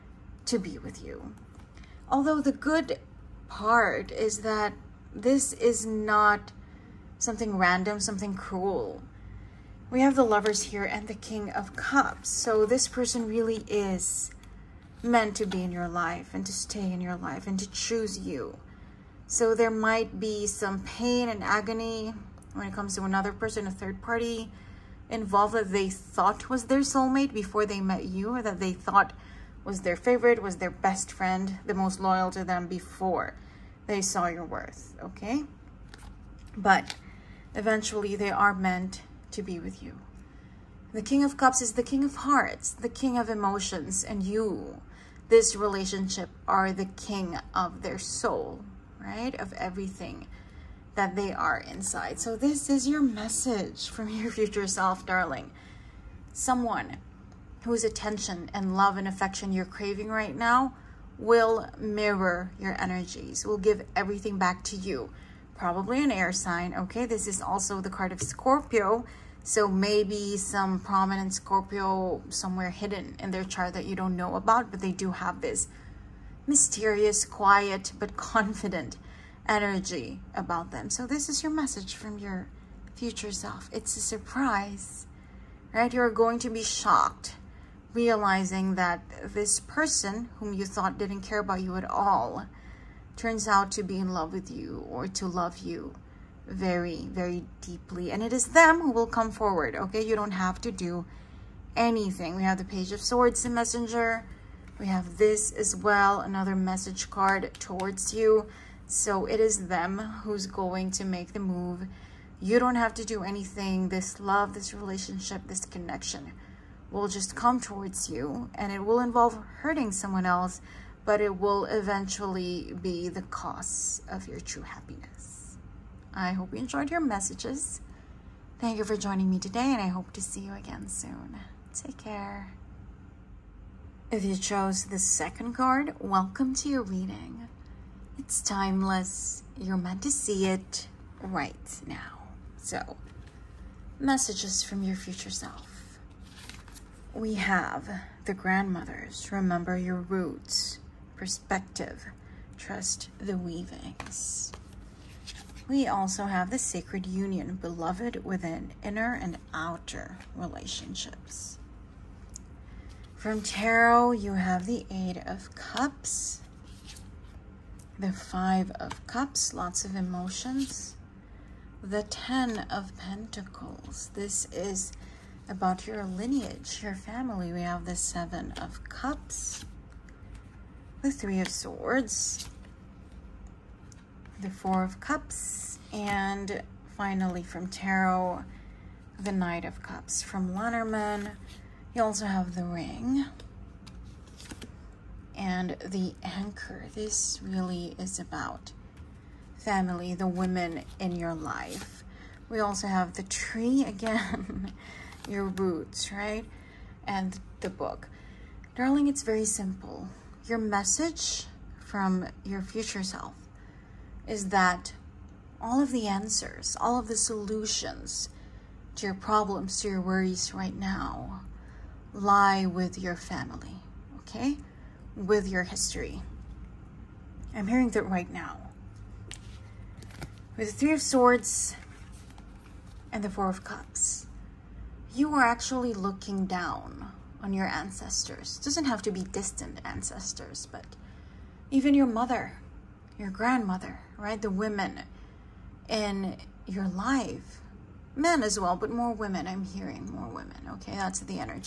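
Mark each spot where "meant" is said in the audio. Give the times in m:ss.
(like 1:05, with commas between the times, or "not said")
0:15, 0:38, 2:19.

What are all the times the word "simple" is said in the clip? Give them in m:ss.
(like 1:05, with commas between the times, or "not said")
3:29.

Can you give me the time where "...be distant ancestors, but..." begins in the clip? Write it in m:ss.
3:59.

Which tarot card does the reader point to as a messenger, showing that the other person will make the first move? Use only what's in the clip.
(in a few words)
Page of Swords.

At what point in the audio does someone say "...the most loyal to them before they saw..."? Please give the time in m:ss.
0:31.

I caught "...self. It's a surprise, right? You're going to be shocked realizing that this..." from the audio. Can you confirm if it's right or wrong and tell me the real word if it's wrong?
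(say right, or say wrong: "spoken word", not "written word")
right.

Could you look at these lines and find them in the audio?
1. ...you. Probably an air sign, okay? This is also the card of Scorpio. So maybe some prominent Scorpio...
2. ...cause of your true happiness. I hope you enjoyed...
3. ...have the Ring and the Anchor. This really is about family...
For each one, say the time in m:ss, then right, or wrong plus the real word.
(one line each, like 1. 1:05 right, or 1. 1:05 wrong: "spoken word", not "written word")
1. 1:04 right
2. 2:03 right
3. 3:12 right.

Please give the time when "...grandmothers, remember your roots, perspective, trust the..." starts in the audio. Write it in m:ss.
2:28.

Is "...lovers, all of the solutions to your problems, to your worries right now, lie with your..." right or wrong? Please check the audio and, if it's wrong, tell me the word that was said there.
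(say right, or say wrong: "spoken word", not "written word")
wrong: "answers", not "lovers".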